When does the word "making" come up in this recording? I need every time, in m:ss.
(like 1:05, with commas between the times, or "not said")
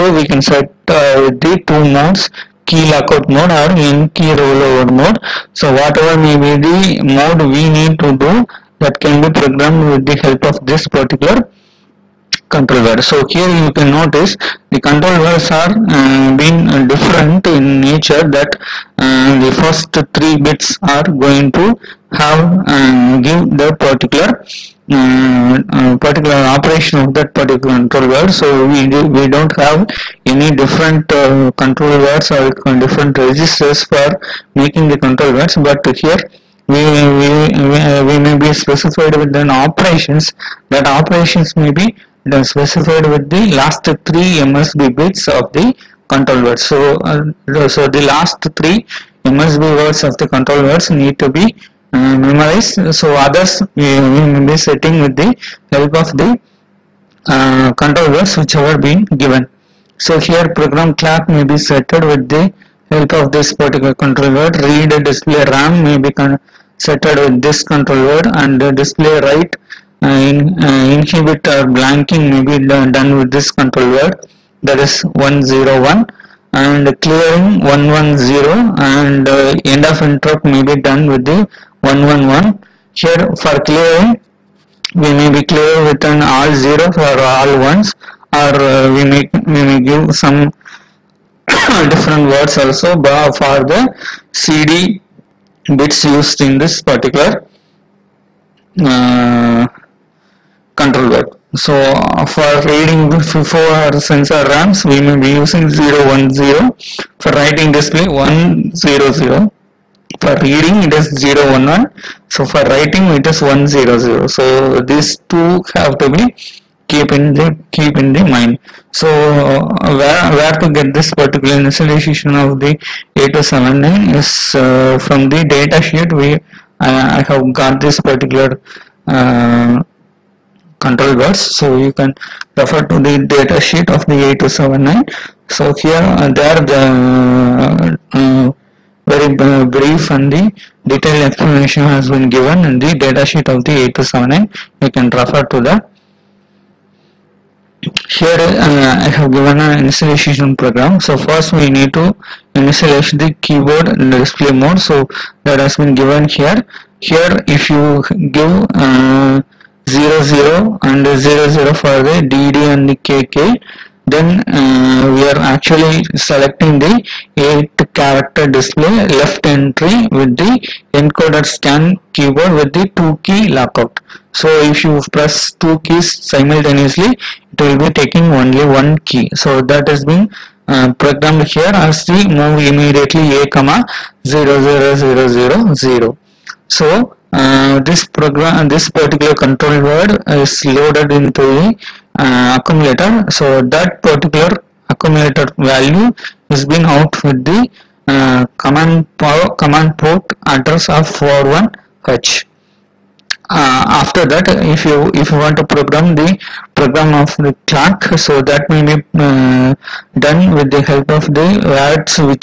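0:34.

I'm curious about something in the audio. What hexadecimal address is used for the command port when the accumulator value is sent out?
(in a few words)
41h.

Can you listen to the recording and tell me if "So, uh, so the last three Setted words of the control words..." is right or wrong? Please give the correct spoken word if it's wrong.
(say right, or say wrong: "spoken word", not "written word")
wrong: "MSB", not "Setted".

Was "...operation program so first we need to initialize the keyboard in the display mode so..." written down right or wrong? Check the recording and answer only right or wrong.
wrong.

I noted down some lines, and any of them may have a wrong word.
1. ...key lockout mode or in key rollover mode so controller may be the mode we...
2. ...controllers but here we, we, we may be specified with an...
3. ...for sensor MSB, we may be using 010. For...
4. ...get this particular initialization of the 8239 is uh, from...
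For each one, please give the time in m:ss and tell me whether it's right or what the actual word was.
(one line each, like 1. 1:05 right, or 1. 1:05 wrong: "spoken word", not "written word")
1. 0:02 wrong: "whatever", not "controller"
2. 0:34 right
3. 1:43 wrong: "RAMs", not "MSB"
4. 2:00 wrong: "8279", not "8239".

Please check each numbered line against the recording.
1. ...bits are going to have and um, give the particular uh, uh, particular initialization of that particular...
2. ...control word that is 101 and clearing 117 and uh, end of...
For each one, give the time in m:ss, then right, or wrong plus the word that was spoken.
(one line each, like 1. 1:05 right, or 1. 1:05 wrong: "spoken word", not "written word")
1. 0:20 wrong: "operation", not "initialization"
2. 1:13 wrong: "110", not "117".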